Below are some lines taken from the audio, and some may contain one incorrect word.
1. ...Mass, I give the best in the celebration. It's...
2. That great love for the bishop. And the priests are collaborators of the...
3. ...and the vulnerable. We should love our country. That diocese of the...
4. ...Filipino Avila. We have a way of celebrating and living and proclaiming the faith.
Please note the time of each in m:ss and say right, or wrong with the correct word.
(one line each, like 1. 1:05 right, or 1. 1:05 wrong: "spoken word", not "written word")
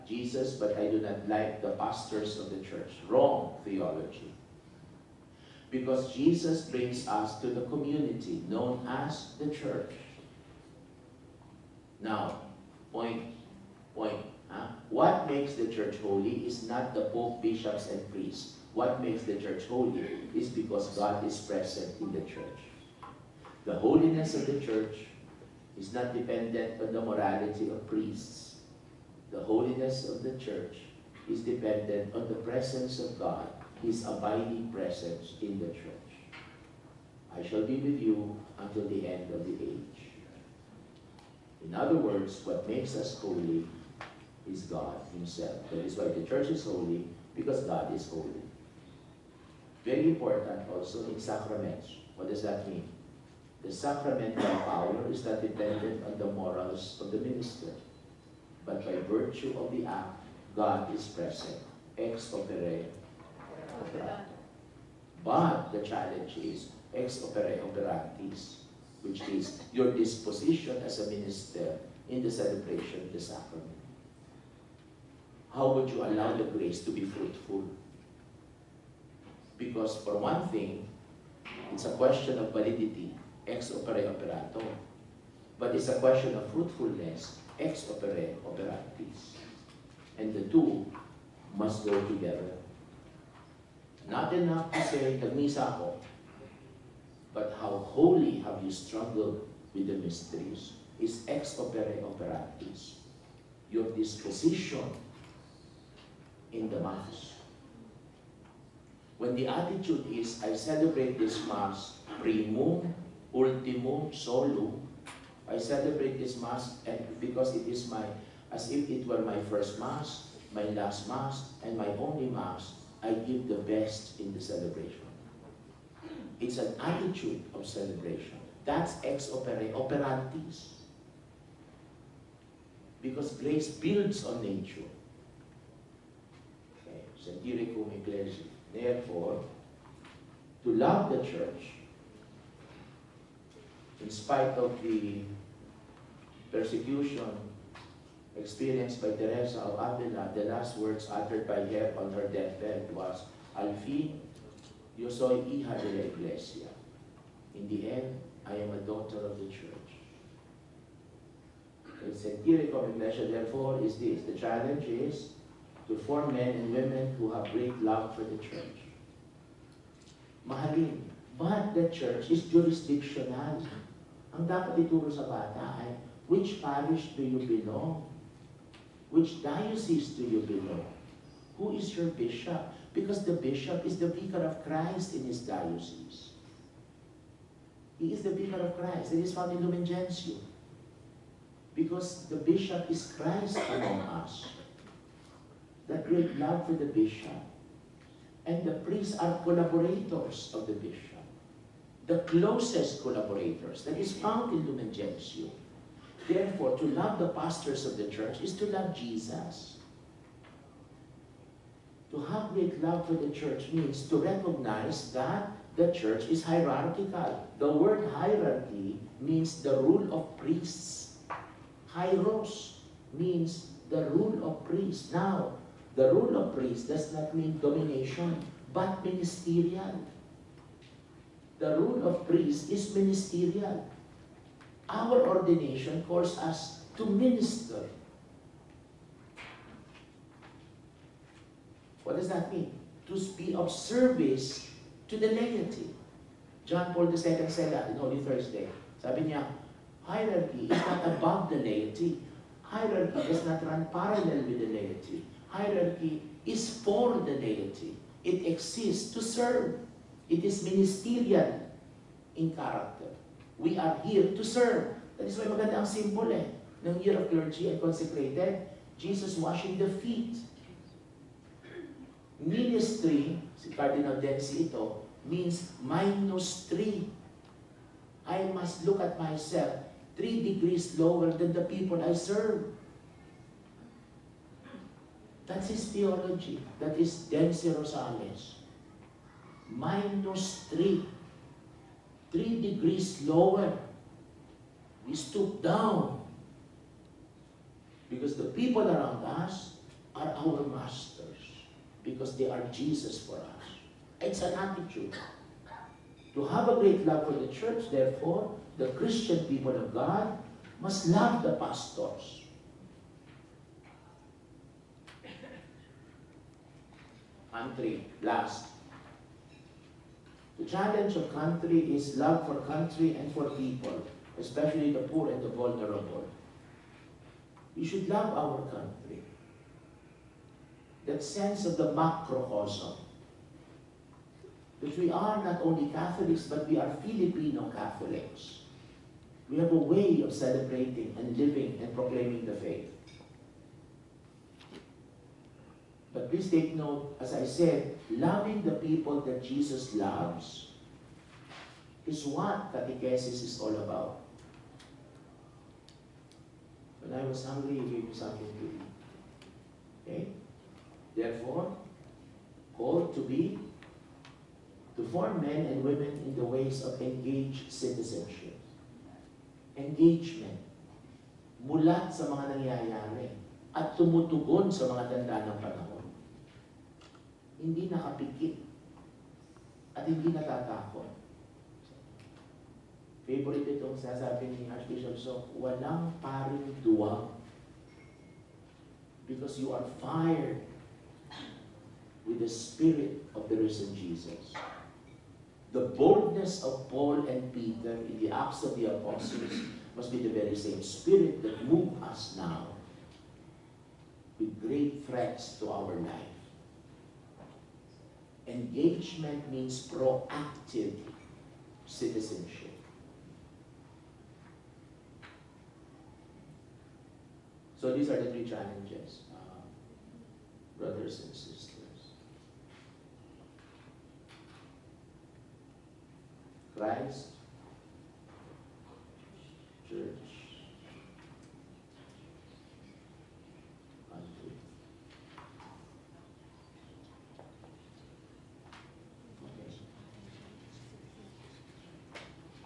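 1. 2:02 right
2. 3:15 right
3. 5:25 wrong: "sense", not "diocese"
4. 5:37 wrong: "Catholics", not "Avila".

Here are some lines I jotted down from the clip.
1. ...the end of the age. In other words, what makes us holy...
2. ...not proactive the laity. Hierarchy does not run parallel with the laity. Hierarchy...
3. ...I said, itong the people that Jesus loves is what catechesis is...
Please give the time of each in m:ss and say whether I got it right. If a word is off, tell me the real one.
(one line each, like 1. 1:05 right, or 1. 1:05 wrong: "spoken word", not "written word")
1. 0:38 right
2. 4:10 wrong: "above", not "proactive"
3. 5:47 wrong: "loving", not "itong".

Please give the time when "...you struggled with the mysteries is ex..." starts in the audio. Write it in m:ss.
1:38.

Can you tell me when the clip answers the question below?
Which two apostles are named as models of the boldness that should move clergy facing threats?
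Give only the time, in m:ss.
6:36.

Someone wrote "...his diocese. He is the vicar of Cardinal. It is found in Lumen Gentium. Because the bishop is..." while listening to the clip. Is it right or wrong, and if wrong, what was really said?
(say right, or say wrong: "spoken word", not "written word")
wrong: "Christ", not "Cardinal".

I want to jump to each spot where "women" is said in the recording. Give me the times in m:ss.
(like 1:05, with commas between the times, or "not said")
2:46, 6:05.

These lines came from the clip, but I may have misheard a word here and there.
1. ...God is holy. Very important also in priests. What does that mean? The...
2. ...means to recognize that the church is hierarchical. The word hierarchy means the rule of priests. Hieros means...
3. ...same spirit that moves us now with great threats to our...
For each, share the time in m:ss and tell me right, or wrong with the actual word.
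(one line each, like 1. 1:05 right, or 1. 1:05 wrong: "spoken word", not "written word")
1. 0:47 wrong: "sacraments", not "priests"
2. 3:33 right
3. 6:40 right.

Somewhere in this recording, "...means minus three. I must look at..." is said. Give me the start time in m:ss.
4:35.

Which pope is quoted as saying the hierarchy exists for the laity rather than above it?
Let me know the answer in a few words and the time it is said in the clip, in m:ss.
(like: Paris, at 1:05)
John Paul II, at 4:06.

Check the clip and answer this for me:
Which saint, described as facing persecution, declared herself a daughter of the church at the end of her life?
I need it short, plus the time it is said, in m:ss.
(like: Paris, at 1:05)
Teresa of Avila, at 2:29.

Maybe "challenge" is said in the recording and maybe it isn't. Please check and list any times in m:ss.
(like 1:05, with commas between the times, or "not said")
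1:05, 2:44, 5:20, 6:58.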